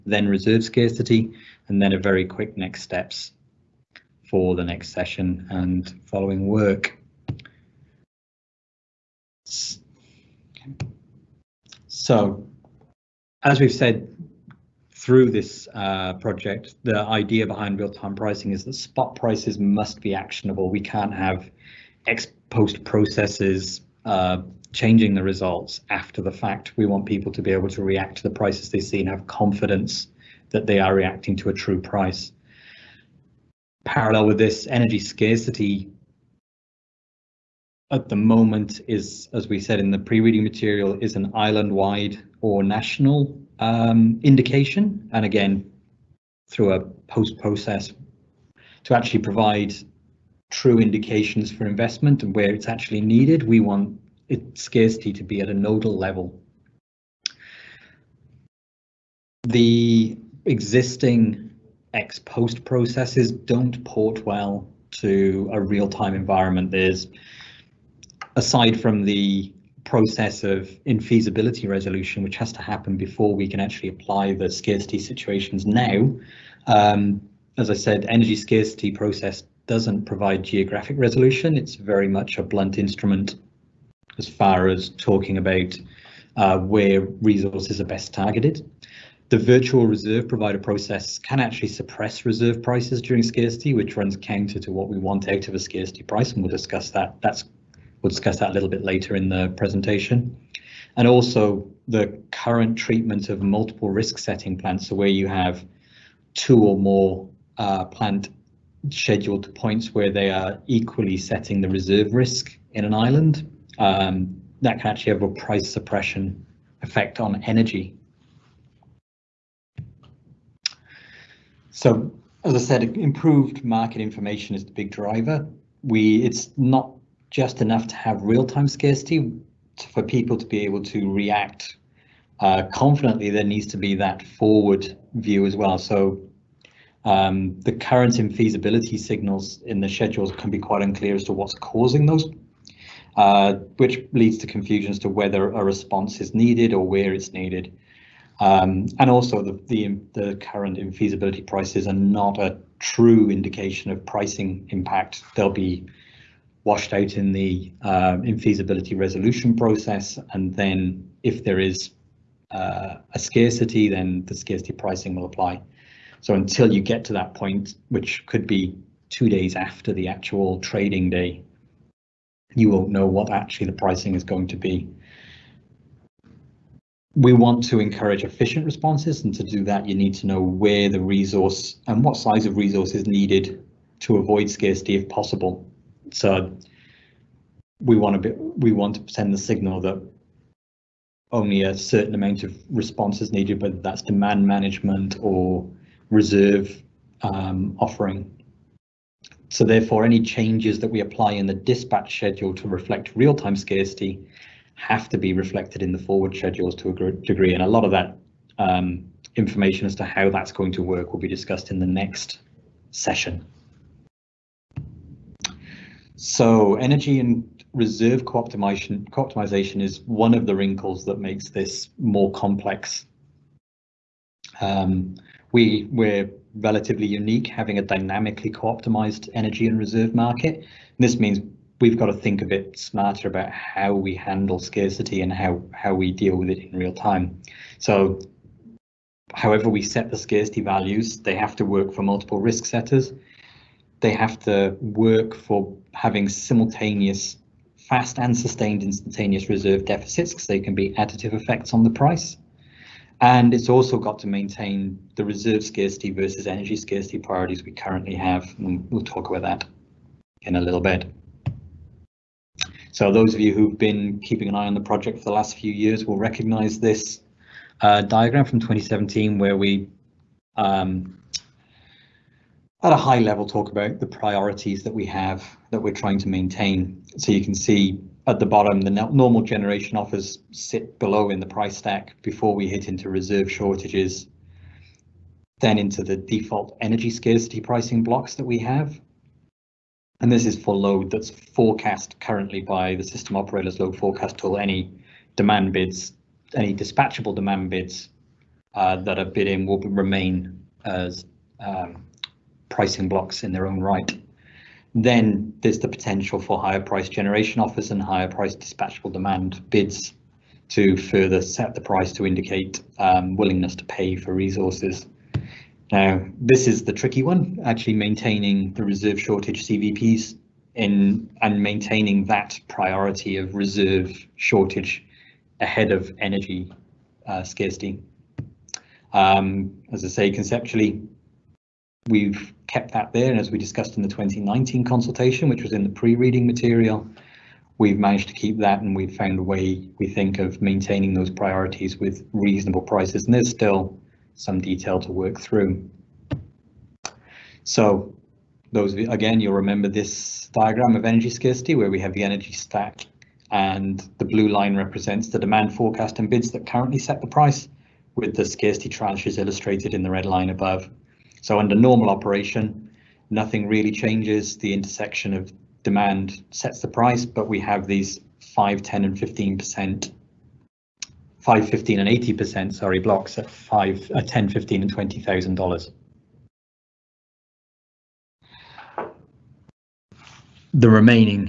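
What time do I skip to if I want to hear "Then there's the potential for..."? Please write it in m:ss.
5:04.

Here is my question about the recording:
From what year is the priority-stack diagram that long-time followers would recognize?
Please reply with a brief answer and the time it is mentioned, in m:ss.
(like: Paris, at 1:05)
2017, at 4:28.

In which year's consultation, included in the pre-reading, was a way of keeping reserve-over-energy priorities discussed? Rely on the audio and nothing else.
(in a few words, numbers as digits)
2019.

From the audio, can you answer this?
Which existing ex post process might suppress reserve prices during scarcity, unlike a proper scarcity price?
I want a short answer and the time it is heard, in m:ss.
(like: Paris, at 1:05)
Virtual reserve provider process, at 1:29.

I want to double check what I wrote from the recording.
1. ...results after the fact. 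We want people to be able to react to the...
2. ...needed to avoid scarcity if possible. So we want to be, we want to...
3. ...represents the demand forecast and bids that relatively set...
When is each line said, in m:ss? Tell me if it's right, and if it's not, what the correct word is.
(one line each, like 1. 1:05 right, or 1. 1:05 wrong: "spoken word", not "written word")
1. 0:25 right
2. 3:03 right
3. 5:54 wrong: "currently", not "relatively".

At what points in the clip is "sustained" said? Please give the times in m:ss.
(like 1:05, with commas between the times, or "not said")
4:08.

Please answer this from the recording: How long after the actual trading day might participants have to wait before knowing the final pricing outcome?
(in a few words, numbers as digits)
Two days.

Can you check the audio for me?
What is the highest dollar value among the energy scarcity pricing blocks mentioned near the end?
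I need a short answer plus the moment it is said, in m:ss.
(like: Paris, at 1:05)
$20,000, at 6:14.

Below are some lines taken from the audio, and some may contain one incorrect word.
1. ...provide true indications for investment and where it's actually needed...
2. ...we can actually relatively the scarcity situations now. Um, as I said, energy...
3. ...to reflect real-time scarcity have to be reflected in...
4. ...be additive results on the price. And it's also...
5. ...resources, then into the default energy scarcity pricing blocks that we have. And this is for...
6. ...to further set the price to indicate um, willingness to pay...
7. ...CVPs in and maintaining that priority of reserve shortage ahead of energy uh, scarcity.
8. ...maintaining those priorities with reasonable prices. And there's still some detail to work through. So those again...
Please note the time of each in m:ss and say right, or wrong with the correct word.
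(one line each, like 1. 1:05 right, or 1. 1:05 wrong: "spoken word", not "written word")
1. 0:49 right
2. 1:13 wrong: "apply", not "relatively"
3. 3:22 right
4. 4:10 wrong: "effects", not "results"
5. 4:43 wrong: "shortages", not "resources"
6. 5:10 right
7. 5:19 right
8. 5:40 right.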